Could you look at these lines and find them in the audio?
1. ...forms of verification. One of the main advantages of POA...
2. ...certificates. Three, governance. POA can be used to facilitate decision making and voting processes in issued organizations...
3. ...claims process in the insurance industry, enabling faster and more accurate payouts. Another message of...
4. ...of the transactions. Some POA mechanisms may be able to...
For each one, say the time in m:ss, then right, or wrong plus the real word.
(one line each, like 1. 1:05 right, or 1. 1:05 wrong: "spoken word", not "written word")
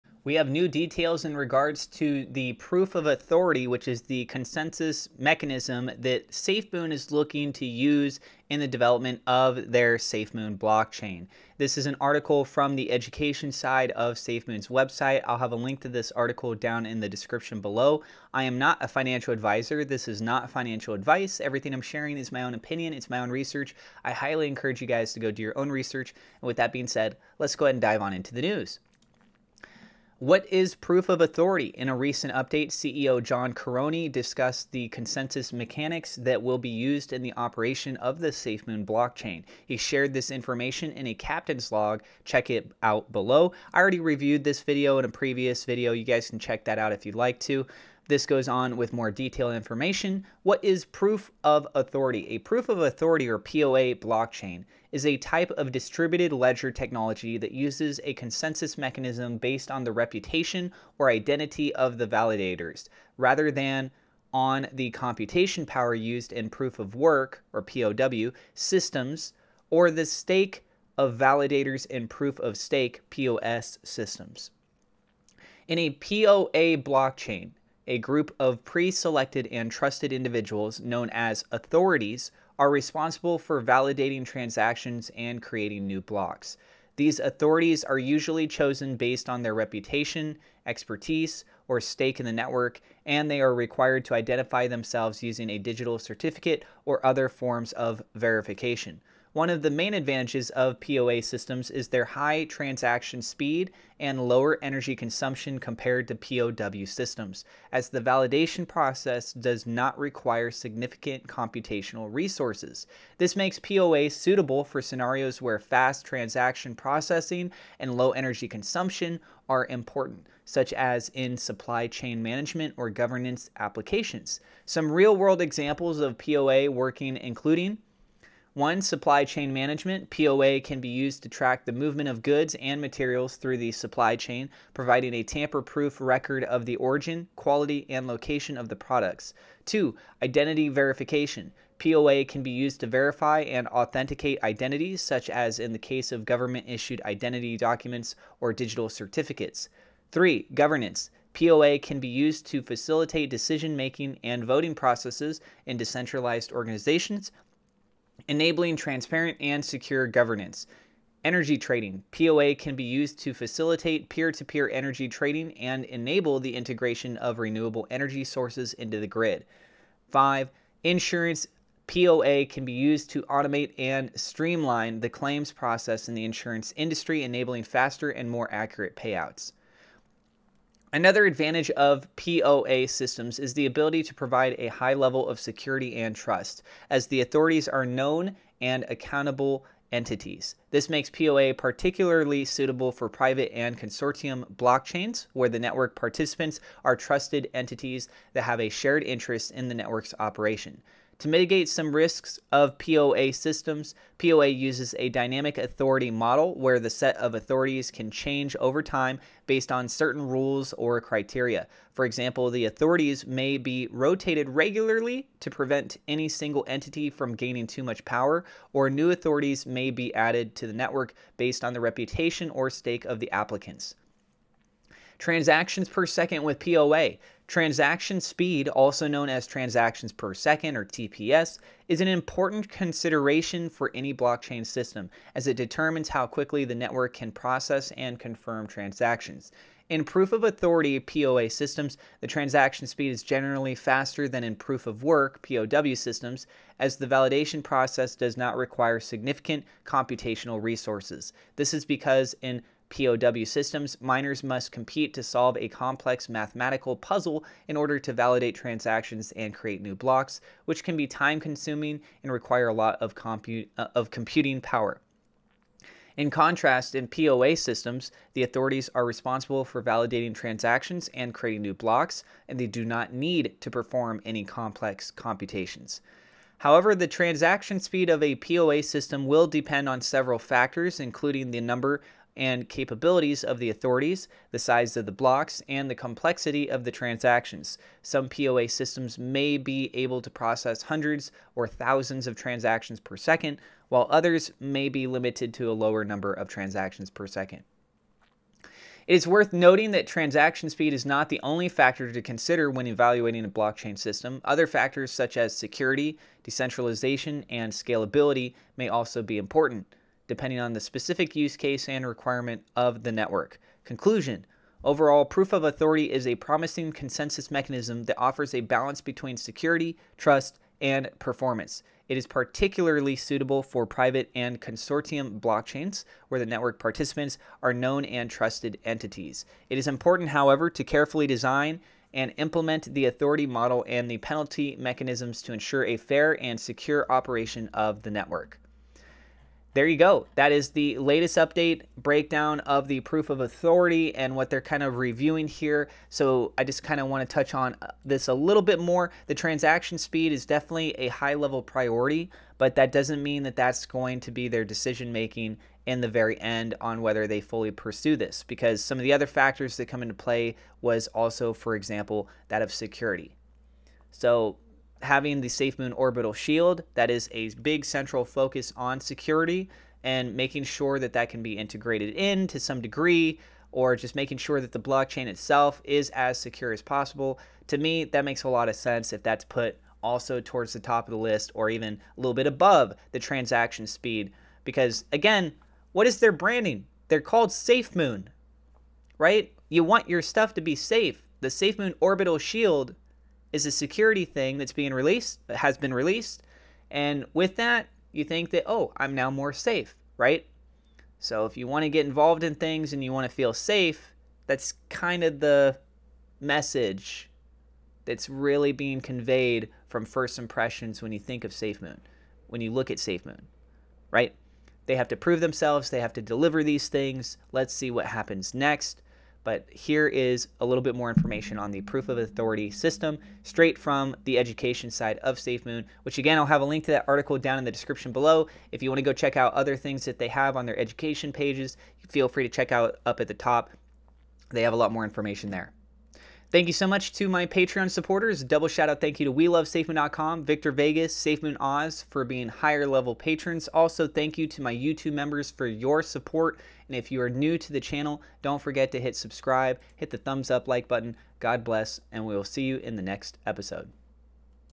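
1. 1:37 right
2. 2:28 wrong: "decentralized", not "issued"
3. 2:55 wrong: "advantage", not "message"
4. 4:46 wrong: "systems", not "mechanisms".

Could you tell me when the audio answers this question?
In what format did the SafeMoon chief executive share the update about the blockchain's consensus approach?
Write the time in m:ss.
0:41.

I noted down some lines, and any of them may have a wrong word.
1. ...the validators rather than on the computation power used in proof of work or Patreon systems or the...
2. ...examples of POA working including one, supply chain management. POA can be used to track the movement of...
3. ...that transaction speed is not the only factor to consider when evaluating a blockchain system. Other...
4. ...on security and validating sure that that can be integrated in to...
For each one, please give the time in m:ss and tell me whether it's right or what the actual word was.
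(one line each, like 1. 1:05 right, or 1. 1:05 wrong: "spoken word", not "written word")
1. 1:01 wrong: "POW", not "Patreon"
2. 2:05 right
3. 4:59 right
4. 6:08 wrong: "making", not "validating".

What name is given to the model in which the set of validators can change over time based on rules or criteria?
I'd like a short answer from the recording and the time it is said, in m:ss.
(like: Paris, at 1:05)
dynamic authority model, at 3:25.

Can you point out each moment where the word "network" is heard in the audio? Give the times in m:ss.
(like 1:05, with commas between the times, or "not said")
1:32, 3:15, 3:19, 3:40, 3:56, 5:13, 5:26, 5:38.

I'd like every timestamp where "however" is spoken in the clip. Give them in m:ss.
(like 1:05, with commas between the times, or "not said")
4:36, 5:30.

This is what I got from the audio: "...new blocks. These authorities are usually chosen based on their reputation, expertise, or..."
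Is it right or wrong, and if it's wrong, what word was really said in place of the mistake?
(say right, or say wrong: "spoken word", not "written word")
right.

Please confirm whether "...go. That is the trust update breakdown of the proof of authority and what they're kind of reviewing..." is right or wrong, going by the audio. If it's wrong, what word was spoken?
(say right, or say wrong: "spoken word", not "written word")
wrong: "latest", not "trust".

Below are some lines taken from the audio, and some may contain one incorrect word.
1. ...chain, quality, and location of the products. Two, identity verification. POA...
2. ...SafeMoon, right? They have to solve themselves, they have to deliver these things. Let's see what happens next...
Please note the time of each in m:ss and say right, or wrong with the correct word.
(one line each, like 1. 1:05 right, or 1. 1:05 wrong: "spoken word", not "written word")
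1. 2:16 wrong: "origin", not "chain"
2. 6:52 wrong: "prove", not "solve".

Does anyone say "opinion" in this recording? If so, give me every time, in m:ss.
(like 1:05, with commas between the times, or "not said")
0:22.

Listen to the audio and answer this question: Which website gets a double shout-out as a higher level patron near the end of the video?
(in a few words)
WeLoveSafeMoon.com.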